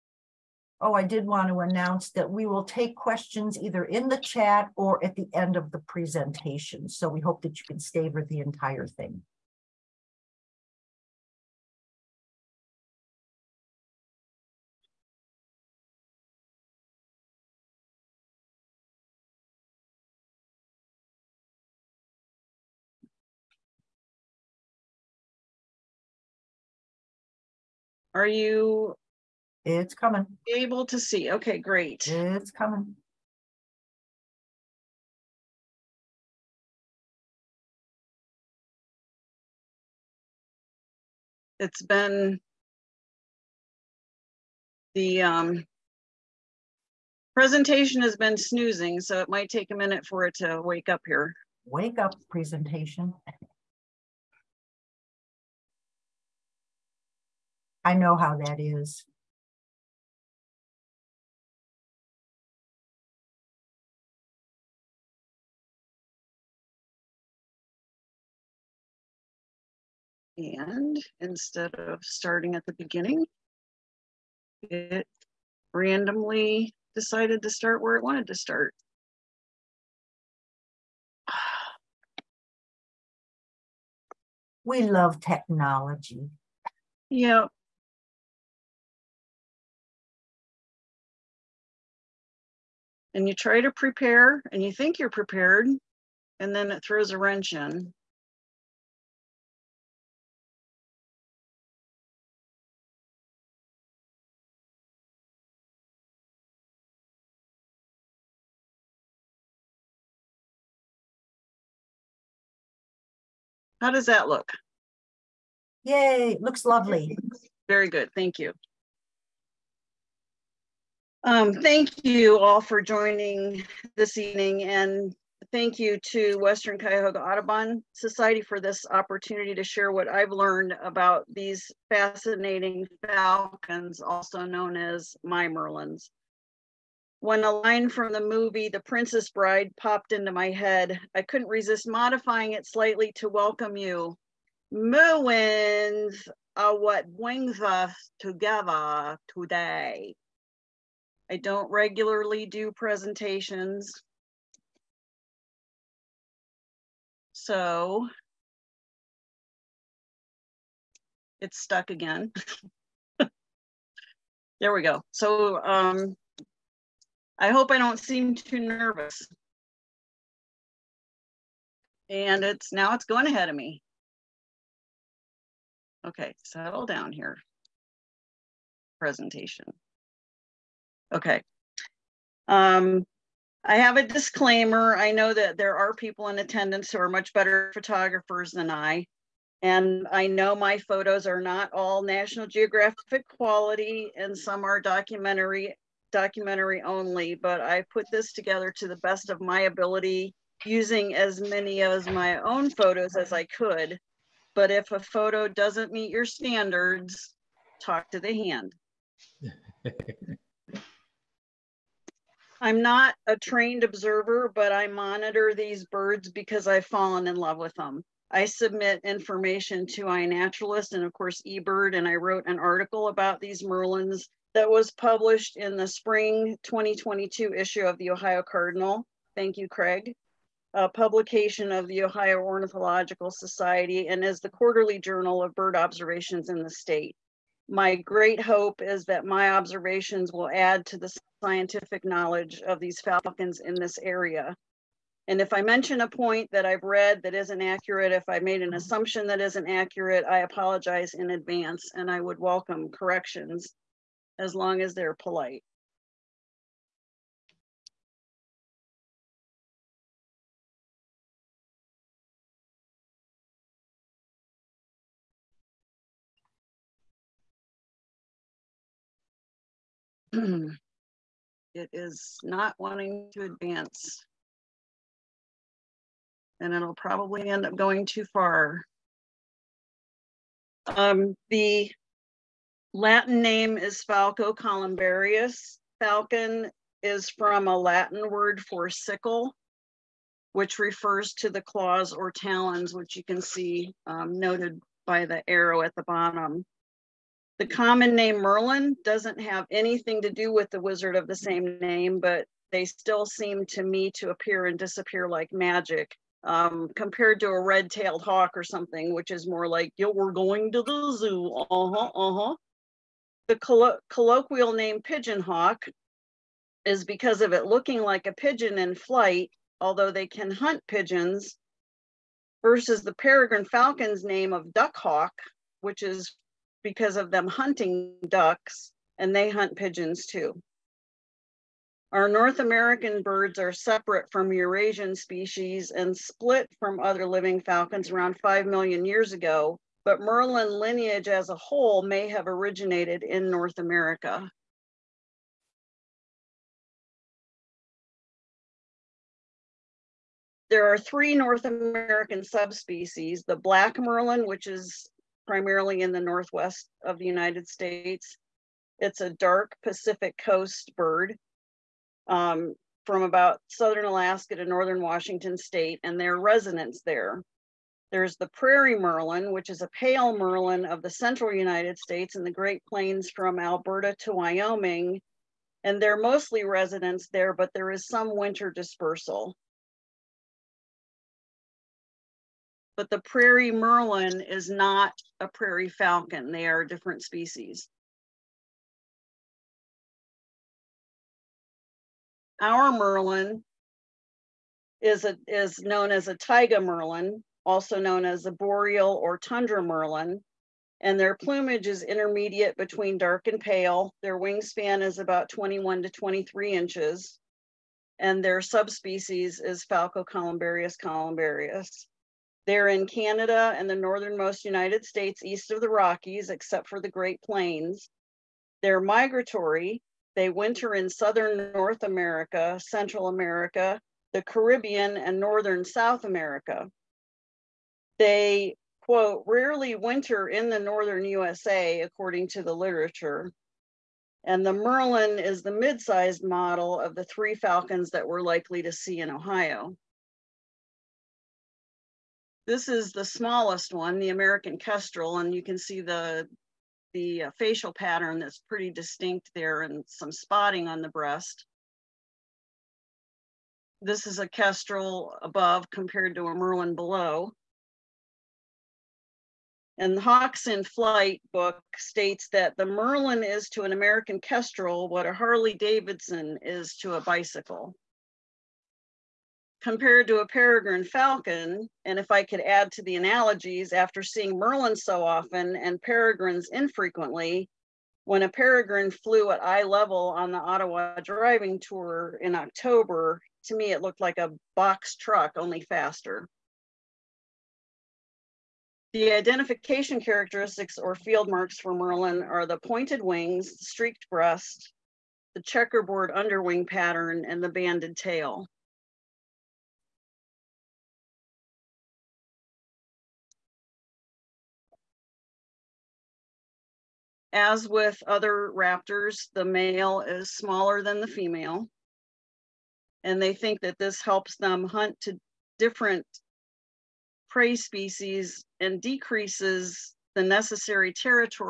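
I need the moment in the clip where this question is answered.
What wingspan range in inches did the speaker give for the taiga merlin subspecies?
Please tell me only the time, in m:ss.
6:45.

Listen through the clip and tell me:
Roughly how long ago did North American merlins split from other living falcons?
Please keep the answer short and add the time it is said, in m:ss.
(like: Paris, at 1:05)
5 million years, at 5:38.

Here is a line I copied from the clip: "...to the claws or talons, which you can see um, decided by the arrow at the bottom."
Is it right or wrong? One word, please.
wrong.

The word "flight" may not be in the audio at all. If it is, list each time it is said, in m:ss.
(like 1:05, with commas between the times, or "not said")
5:18, 7:40.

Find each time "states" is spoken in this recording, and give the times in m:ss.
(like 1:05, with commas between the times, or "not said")
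3:56, 5:57, 6:05, 6:11, 6:55, 7:41.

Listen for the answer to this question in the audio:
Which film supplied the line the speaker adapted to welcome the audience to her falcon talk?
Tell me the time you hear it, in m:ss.
2:18.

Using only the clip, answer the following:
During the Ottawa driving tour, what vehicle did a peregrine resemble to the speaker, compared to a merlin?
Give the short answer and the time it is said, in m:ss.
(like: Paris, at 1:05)
a box truck, at 8:04.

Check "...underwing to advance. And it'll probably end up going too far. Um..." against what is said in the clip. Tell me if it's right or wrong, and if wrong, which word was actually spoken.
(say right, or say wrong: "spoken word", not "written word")
wrong: "wanting", not "underwing".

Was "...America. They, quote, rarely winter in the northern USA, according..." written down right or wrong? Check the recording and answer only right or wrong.
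right.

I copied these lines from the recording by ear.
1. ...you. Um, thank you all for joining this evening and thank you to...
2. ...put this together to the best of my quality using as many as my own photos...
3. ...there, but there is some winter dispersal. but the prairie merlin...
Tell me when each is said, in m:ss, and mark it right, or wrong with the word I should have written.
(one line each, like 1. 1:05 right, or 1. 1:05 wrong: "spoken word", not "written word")
1. 1:58 right
2. 3:17 wrong: "ability", not "quality"
3. 6:17 right.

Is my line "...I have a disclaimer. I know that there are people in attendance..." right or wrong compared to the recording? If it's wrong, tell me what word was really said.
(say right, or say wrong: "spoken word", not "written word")
right.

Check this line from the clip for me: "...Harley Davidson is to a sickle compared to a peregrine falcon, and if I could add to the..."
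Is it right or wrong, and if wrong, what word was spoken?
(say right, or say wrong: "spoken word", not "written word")
wrong: "bicycle", not "sickle".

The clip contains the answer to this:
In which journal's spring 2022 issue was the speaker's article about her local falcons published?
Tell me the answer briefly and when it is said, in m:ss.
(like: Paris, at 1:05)
Ohio Cardinal, at 3:48.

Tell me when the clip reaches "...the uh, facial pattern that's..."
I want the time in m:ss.
7:27.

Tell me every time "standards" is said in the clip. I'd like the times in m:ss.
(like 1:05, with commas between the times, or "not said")
3:26.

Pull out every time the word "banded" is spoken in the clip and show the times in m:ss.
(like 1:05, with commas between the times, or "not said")
8:17.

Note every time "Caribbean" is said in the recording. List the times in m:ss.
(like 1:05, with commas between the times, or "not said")
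7:04.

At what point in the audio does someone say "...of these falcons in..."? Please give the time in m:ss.
4:02.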